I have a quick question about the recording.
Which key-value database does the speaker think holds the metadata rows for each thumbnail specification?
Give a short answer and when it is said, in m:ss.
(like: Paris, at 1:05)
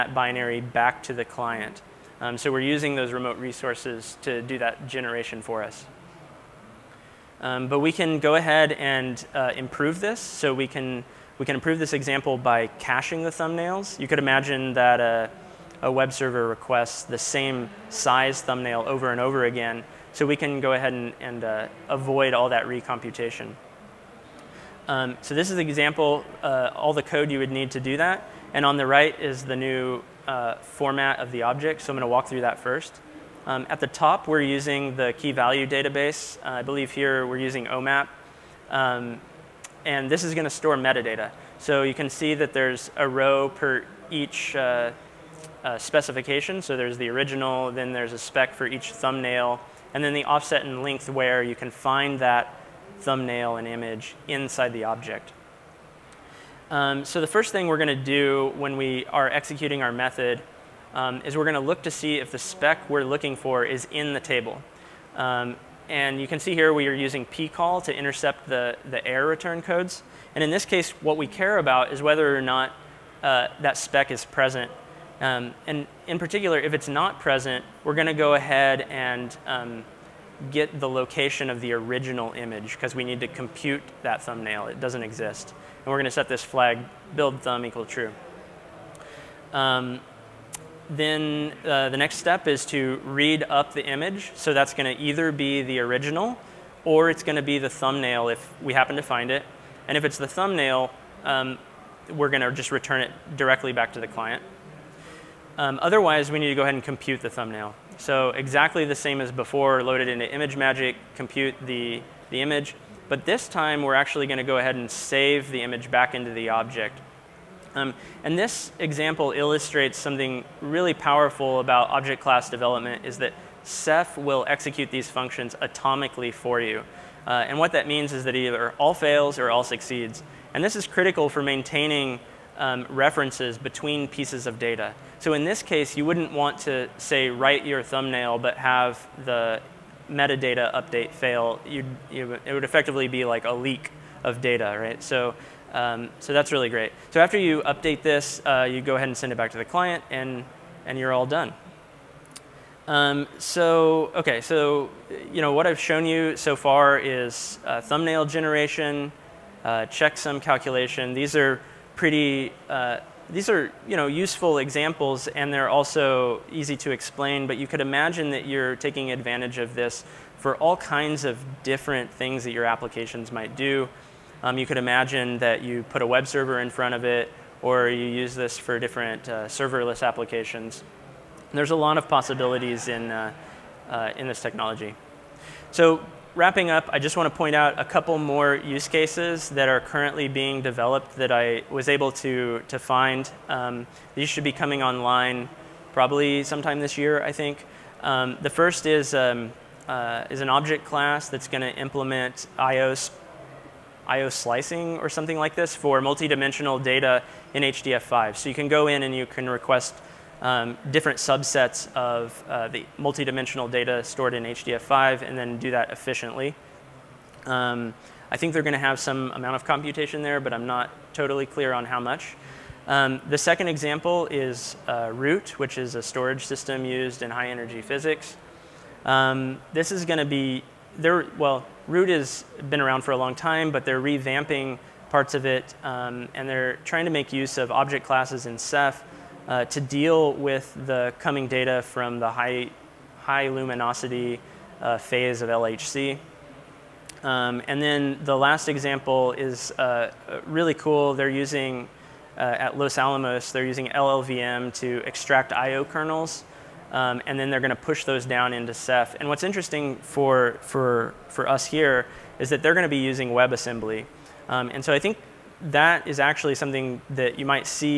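OMAP, at 0:37.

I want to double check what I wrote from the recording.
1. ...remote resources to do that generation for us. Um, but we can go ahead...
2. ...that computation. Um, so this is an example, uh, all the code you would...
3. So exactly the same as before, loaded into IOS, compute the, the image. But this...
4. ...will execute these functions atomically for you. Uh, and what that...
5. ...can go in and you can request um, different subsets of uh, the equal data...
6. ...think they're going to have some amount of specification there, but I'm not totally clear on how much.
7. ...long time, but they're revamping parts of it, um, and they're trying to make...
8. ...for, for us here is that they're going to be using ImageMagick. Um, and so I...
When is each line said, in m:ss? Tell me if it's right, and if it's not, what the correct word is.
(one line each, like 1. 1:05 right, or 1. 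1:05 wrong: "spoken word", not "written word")
1. 0:03 right
2. 0:22 wrong: "recomputation", not "computation"
3. 1:47 wrong: "ImageMagick", not "IOS"
4. 2:04 right
5. 3:28 wrong: "multidimensional", not "equal"
6. 3:38 wrong: "computation", not "specification"
7. 3:53 right
8. 4:20 wrong: "WebAssembly", not "ImageMagick".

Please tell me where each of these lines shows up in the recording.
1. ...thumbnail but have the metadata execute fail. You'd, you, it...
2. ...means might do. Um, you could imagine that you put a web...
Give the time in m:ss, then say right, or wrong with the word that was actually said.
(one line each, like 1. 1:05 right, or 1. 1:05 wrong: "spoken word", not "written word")
1. 2:17 wrong: "update", not "execute"
2. 2:52 wrong: "applications", not "means".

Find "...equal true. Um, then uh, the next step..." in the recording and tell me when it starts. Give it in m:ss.
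1:27.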